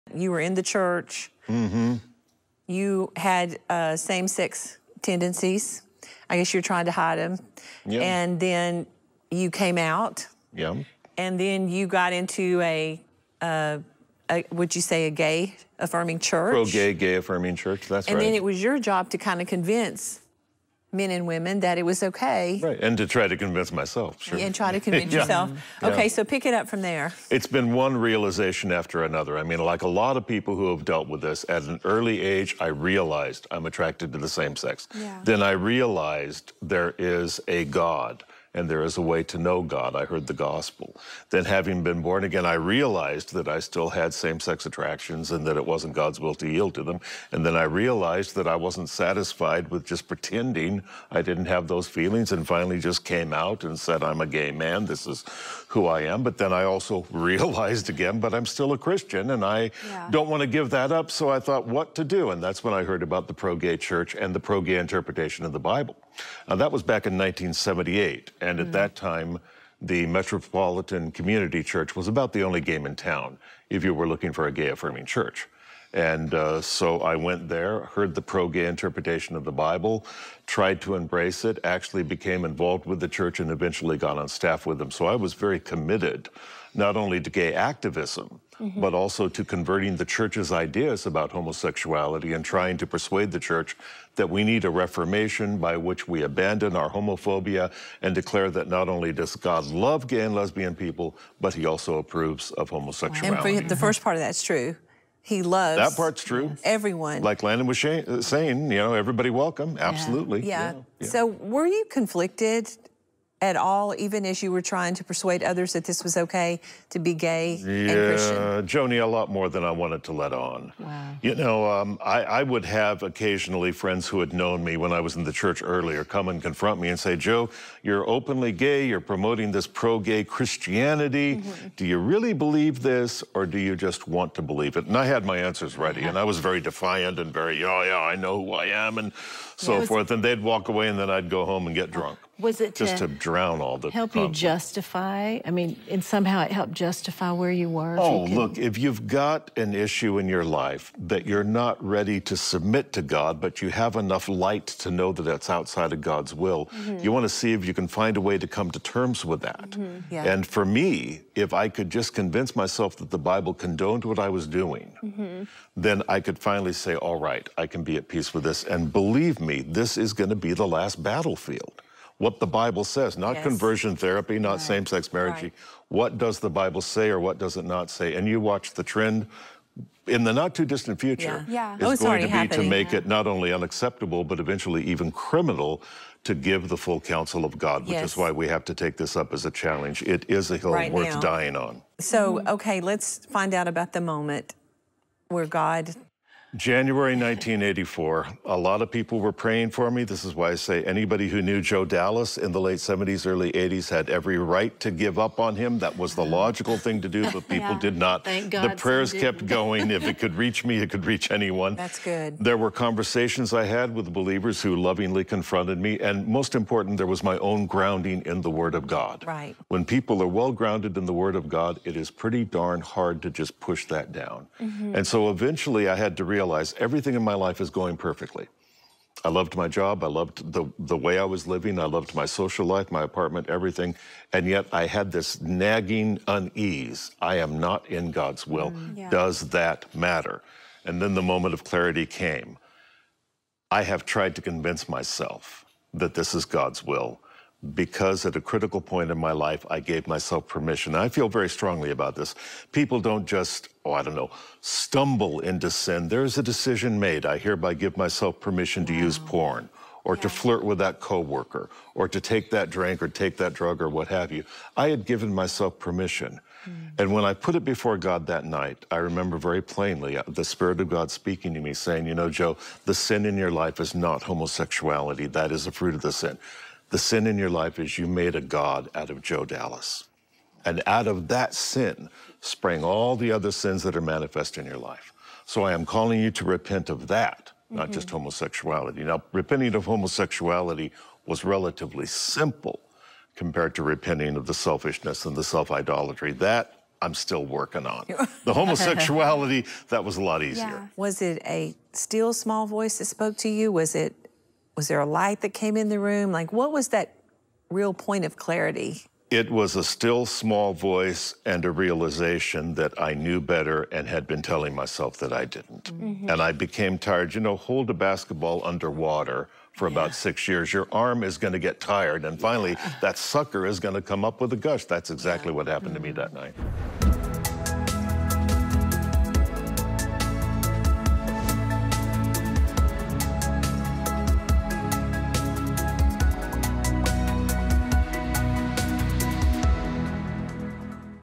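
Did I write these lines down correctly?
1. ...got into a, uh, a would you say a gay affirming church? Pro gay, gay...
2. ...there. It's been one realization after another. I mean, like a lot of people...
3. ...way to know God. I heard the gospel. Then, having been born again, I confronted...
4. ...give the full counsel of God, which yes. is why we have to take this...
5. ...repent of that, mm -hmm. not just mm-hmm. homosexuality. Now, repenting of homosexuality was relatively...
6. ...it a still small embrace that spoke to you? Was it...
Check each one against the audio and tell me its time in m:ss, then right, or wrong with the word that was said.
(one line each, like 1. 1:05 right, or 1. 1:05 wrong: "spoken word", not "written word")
1. 0:11 right
2. 0:26 right
3. 0:39 wrong: "realized", not "confronted"
4. 3:06 right
5. 4:46 right
6. 5:01 wrong: "voice", not "embrace".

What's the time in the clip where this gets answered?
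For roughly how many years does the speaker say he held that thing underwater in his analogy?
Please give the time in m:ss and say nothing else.
5:20.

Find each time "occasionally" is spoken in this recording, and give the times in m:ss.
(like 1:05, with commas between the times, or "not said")
2:03.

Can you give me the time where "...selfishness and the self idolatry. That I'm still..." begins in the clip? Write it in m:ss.
4:54.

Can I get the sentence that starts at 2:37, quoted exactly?
you want to see if you can find a way to come to terms with that.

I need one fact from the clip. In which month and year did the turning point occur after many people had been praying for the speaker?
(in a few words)
January 1984.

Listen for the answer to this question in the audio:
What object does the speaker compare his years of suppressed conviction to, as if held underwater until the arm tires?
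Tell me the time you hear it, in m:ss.
5:17.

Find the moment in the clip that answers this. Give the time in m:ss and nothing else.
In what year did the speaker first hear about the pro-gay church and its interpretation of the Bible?
1:07.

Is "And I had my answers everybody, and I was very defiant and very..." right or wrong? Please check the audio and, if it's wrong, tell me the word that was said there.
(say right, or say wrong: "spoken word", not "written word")
wrong: "ready", not "everybody".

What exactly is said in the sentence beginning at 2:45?
then I could finally say, all right, I can be at peace with this.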